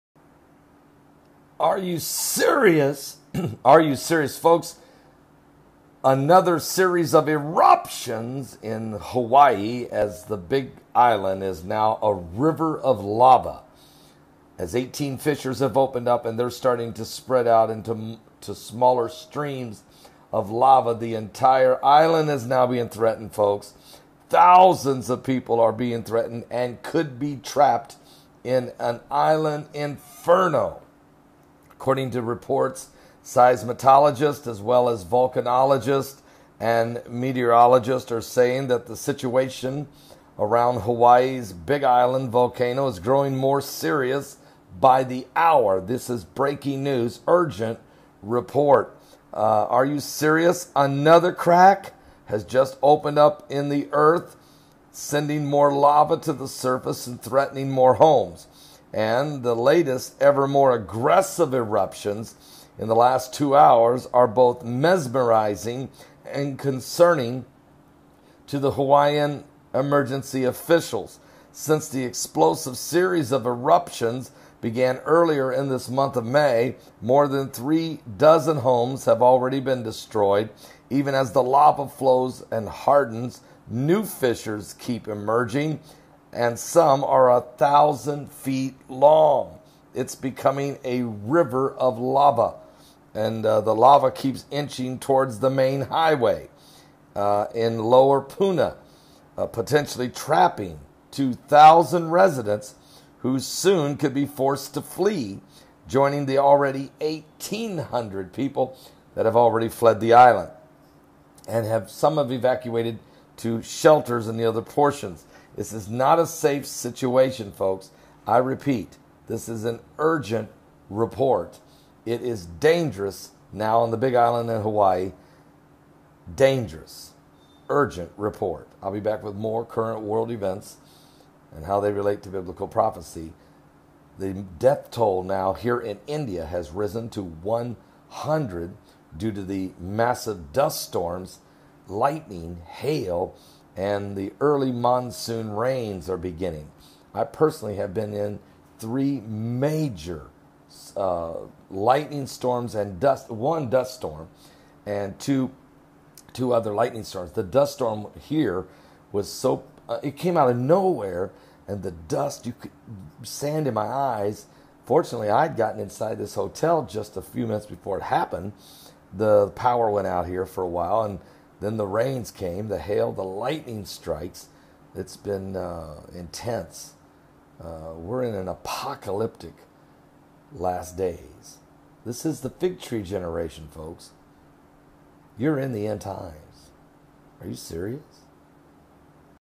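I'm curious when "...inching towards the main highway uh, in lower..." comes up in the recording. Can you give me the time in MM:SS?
01:34.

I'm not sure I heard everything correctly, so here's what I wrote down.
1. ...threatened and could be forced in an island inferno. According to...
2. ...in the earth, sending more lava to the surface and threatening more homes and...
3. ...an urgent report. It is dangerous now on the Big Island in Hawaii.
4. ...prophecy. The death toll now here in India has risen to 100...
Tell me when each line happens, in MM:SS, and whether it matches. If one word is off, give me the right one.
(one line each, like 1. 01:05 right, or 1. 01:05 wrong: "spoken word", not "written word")
1. 00:26 wrong: "trapped", not "forced"
2. 00:53 right
3. 01:59 right
4. 02:12 right.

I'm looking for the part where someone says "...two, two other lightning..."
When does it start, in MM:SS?
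02:35.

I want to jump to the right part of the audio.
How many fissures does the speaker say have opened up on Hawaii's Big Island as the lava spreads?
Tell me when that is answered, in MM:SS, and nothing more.
00:14.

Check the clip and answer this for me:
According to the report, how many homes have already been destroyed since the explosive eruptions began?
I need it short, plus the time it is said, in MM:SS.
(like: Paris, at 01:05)
more than three dozen, at 01:17.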